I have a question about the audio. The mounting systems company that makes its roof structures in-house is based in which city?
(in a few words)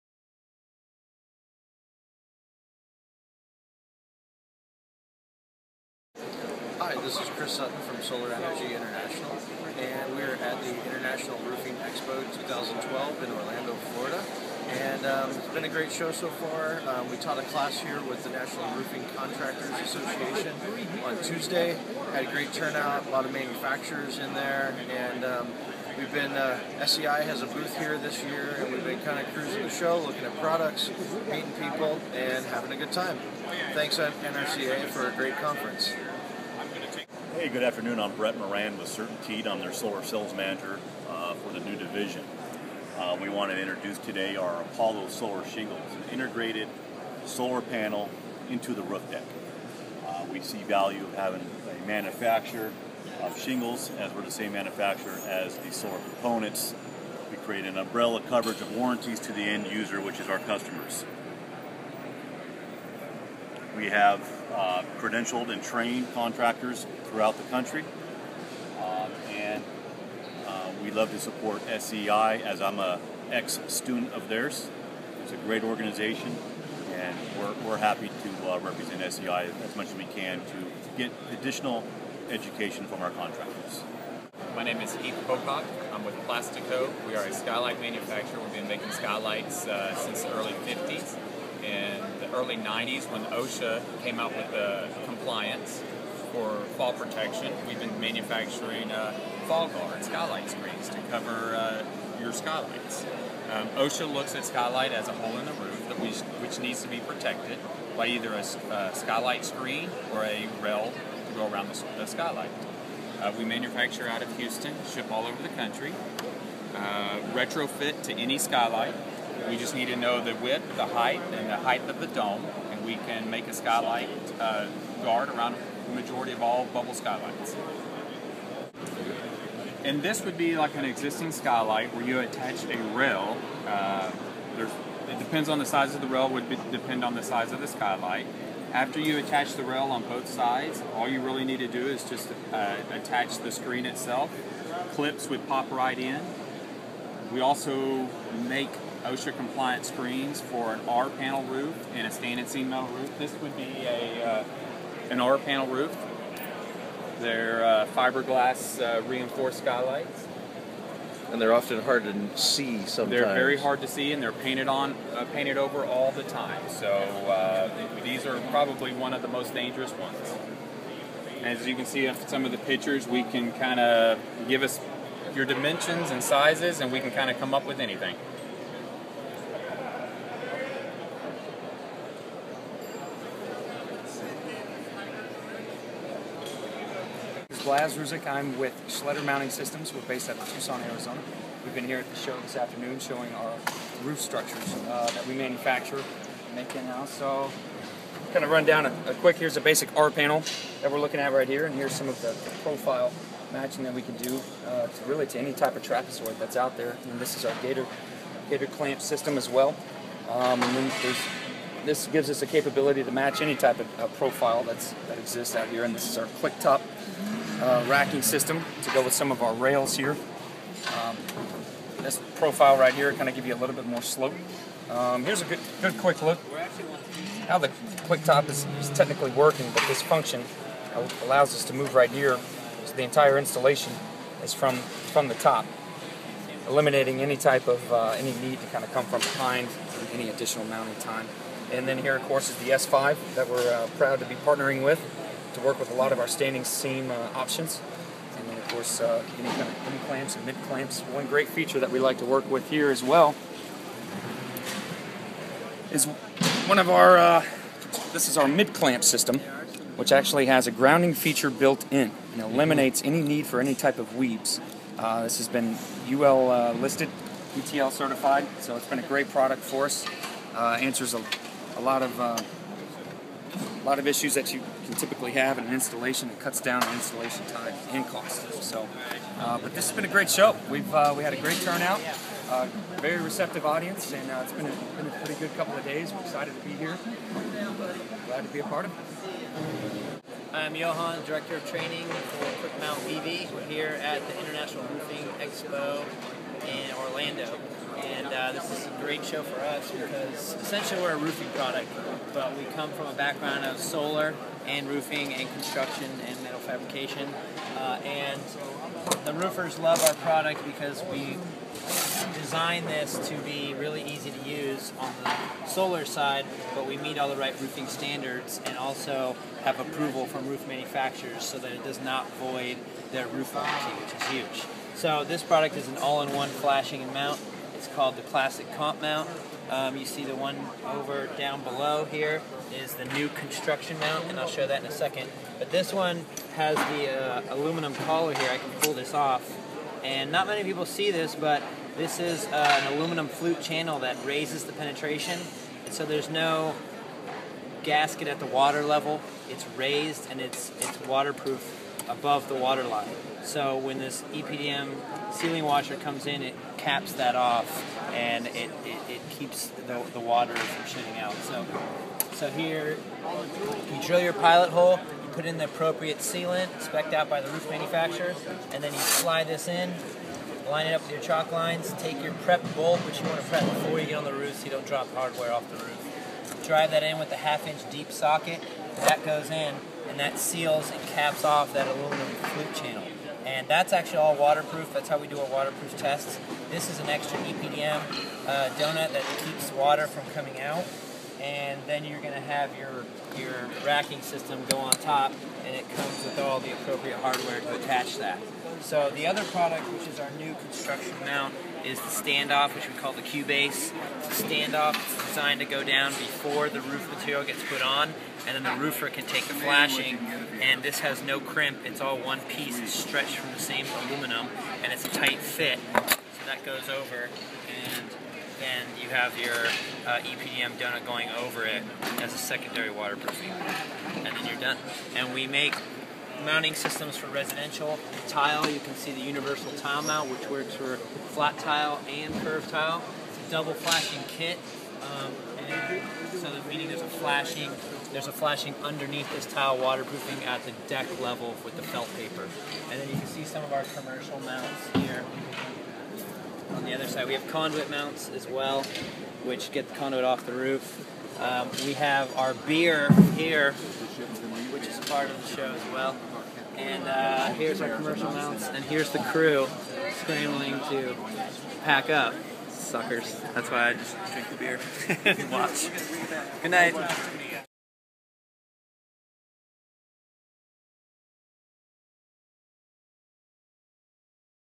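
Tucson, Arizona.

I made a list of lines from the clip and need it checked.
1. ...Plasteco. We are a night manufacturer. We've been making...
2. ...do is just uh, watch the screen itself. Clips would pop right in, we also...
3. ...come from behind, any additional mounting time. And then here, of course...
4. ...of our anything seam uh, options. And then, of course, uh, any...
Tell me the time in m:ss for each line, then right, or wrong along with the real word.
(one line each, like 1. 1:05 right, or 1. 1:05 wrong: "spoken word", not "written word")
1. 1:26 wrong: "skylight", not "night"
2. 2:21 wrong: "attach", not "watch"
3. 3:58 right
4. 4:06 wrong: "standing", not "anything".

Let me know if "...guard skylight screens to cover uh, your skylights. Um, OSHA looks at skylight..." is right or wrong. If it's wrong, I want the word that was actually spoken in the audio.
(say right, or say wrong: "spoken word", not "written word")
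right.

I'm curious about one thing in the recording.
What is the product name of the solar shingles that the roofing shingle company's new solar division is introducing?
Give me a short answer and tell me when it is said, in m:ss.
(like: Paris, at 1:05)
Apollo, at 0:44.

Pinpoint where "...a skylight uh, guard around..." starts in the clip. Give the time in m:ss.
2:03.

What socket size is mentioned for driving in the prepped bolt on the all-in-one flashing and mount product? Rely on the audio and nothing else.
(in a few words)
Half inch deep socket.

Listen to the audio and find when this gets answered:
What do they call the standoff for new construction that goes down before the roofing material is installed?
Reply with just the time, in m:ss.
6:43.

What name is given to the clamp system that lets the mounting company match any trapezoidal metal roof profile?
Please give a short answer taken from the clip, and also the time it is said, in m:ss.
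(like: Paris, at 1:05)
Gator clamp, at 3:28.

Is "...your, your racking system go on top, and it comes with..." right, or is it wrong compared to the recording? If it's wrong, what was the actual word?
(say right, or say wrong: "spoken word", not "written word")
right.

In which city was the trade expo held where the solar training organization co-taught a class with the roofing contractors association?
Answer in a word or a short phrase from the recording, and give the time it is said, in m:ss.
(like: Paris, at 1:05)
Orlando, Florida, at 0:13.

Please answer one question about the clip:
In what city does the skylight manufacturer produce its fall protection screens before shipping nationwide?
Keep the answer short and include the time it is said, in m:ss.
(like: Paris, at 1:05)
Houston, at 1:54.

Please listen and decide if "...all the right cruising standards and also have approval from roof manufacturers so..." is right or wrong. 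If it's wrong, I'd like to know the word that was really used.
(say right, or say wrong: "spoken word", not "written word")
wrong: "roofing", not "cruising".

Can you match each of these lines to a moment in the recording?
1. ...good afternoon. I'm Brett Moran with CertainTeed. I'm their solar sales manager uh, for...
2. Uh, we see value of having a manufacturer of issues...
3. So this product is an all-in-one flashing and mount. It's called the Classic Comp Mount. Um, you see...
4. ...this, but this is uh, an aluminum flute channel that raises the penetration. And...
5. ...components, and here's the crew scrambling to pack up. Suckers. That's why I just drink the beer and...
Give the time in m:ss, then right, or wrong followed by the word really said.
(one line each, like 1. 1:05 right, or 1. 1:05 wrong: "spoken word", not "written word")
1. 0:37 right
2. 0:50 wrong: "shingles", not "issues"
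3. 5:24 right
4. 5:41 right
5. 7:38 wrong: "mounts", not "components".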